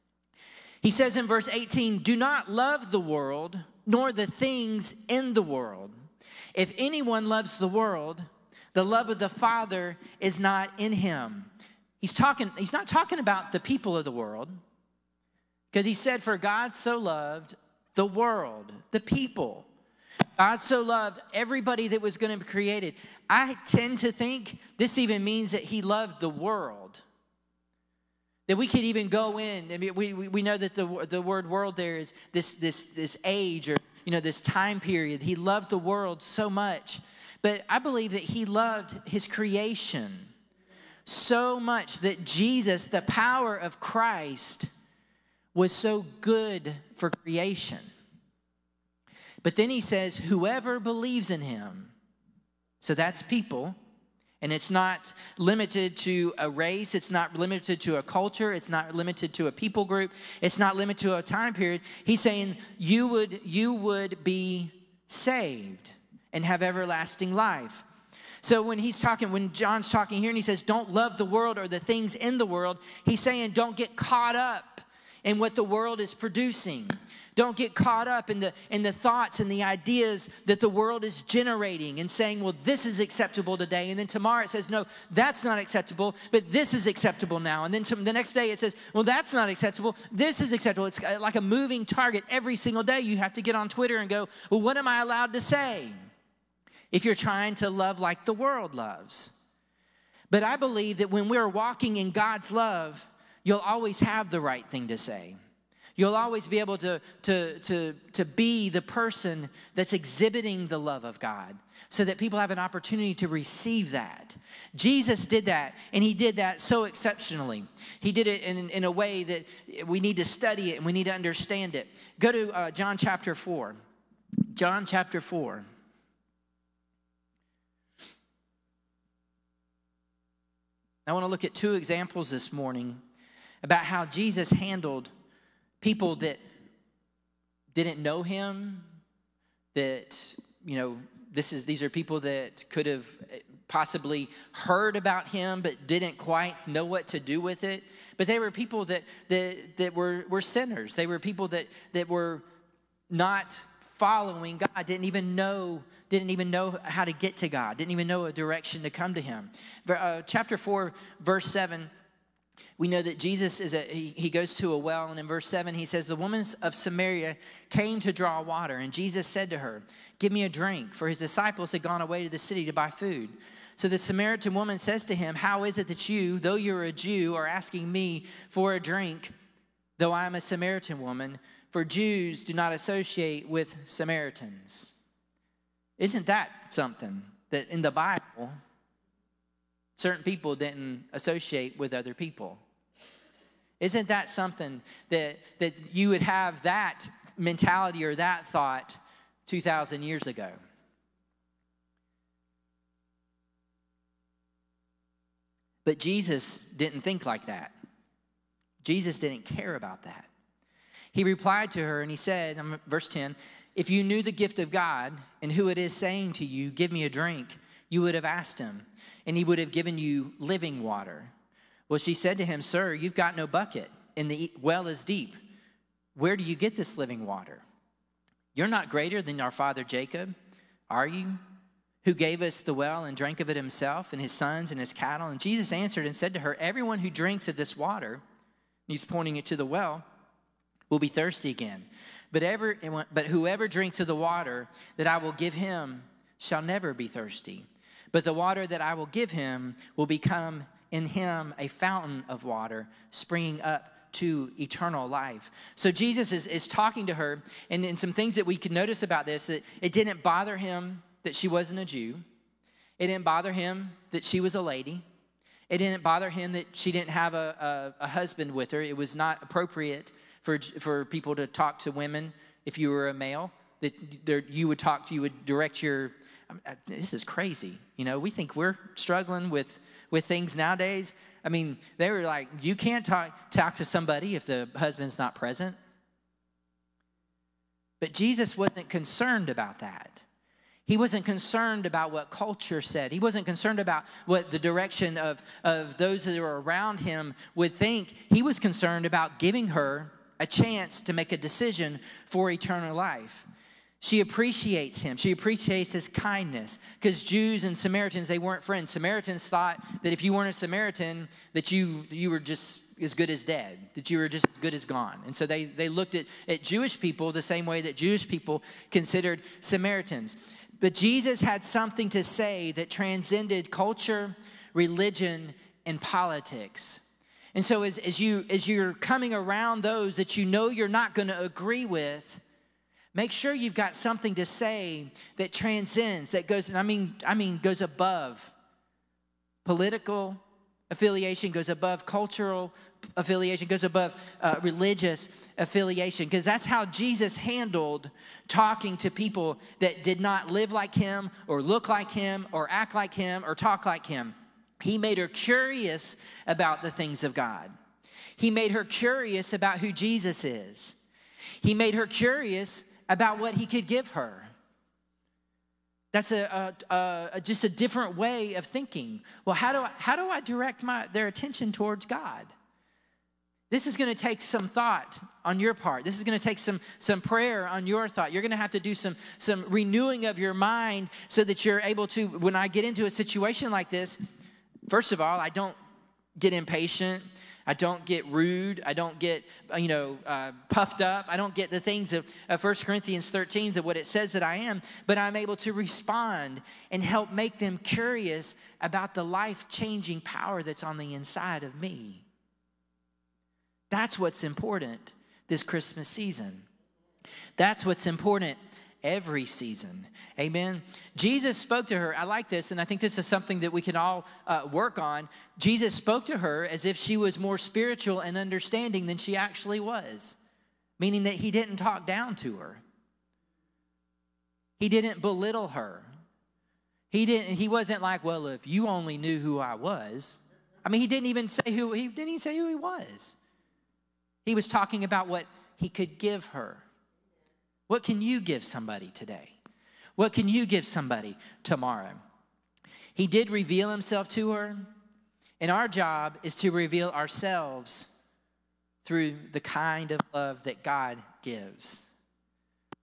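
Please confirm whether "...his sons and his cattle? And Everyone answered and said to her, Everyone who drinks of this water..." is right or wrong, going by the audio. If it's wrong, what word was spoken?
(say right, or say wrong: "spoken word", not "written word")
wrong: "Jesus", not "Everyone".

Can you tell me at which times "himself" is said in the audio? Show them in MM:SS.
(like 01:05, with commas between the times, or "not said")
03:53, 07:23.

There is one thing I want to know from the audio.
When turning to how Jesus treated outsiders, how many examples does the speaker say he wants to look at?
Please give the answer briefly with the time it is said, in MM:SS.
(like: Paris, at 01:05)
2, at 02:11.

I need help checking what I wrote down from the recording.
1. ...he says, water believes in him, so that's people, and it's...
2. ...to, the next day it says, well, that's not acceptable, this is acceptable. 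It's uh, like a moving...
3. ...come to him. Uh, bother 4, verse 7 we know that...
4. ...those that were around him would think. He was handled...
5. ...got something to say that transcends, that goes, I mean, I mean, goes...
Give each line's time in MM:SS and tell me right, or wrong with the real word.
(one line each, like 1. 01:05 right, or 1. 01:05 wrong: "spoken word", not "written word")
1. 00:49 wrong: "whoever", not "water"
2. 01:27 right
3. 02:38 wrong: "chapter", not "bother"
4. 04:55 wrong: "concerned", not "handled"
5. 05:33 right.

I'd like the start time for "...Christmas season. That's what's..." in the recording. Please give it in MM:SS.
06:45.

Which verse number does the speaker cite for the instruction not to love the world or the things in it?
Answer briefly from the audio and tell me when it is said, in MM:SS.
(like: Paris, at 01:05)
18, at 00:01.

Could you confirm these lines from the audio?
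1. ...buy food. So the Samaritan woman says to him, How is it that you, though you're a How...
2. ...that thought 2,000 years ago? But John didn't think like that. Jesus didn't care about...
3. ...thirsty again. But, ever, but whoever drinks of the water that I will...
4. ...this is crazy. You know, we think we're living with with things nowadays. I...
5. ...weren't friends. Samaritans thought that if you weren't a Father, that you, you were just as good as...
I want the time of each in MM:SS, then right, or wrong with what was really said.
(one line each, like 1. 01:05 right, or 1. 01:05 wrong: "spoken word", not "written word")
1. 02:52 wrong: "Jew", not "How"
2. 03:18 wrong: "Jesus", not "John"
3. 04:01 right
4. 04:36 wrong: "struggling", not "living"
5. 05:08 wrong: "Samaritan", not "Father".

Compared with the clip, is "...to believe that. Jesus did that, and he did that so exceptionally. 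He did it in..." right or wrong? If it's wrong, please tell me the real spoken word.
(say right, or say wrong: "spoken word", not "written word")
wrong: "receive", not "believe".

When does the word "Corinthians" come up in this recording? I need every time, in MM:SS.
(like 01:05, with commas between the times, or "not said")
06:32.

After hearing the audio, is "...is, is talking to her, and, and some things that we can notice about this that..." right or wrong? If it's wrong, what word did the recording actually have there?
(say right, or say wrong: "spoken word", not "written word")
right.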